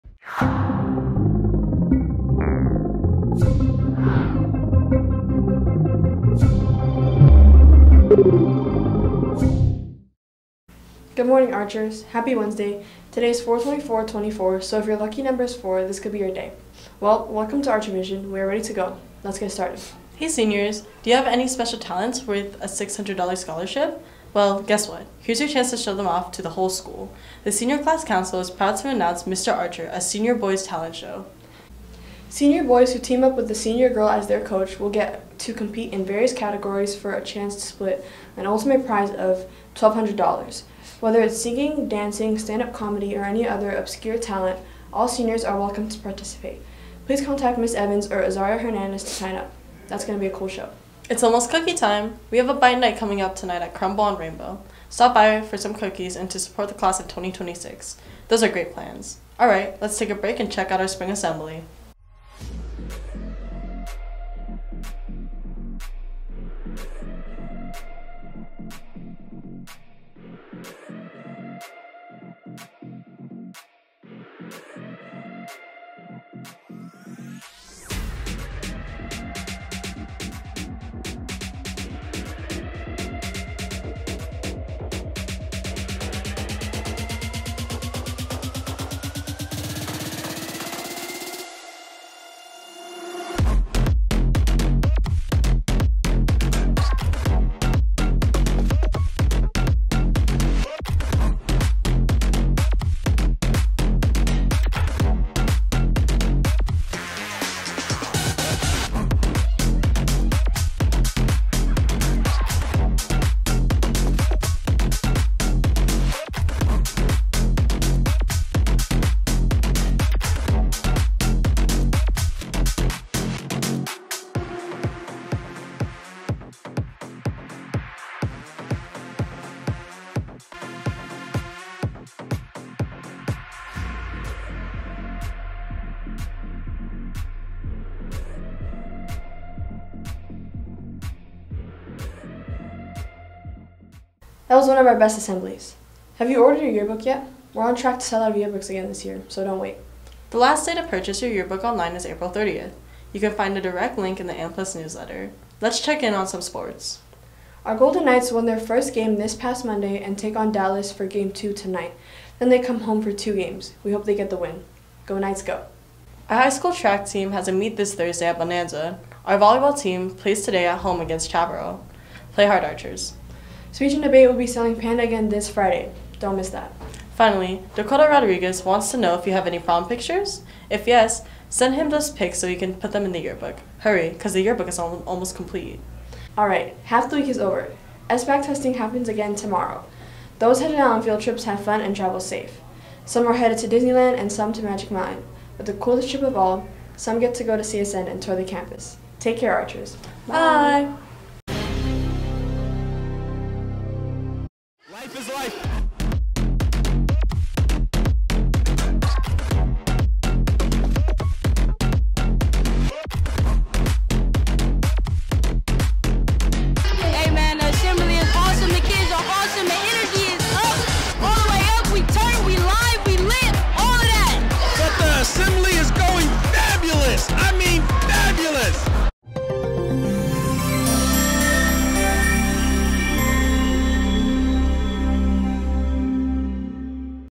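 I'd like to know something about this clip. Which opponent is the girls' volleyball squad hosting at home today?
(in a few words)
Chaparral.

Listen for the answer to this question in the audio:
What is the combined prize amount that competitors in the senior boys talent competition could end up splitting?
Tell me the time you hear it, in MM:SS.
00:39.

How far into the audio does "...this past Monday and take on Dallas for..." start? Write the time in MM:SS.
02:39.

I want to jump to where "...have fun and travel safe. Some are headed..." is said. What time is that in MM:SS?
03:11.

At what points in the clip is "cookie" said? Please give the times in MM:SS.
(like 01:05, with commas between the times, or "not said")
00:51, 00:55.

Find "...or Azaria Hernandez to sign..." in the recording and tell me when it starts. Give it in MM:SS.
00:48.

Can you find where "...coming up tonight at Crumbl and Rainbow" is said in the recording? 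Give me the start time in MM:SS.
00:52.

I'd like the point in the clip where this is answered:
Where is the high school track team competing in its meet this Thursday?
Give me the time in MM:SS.
02:48.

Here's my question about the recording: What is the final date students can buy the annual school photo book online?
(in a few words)
April 30th.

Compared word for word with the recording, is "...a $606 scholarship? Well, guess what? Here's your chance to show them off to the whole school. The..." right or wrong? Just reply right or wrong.
wrong.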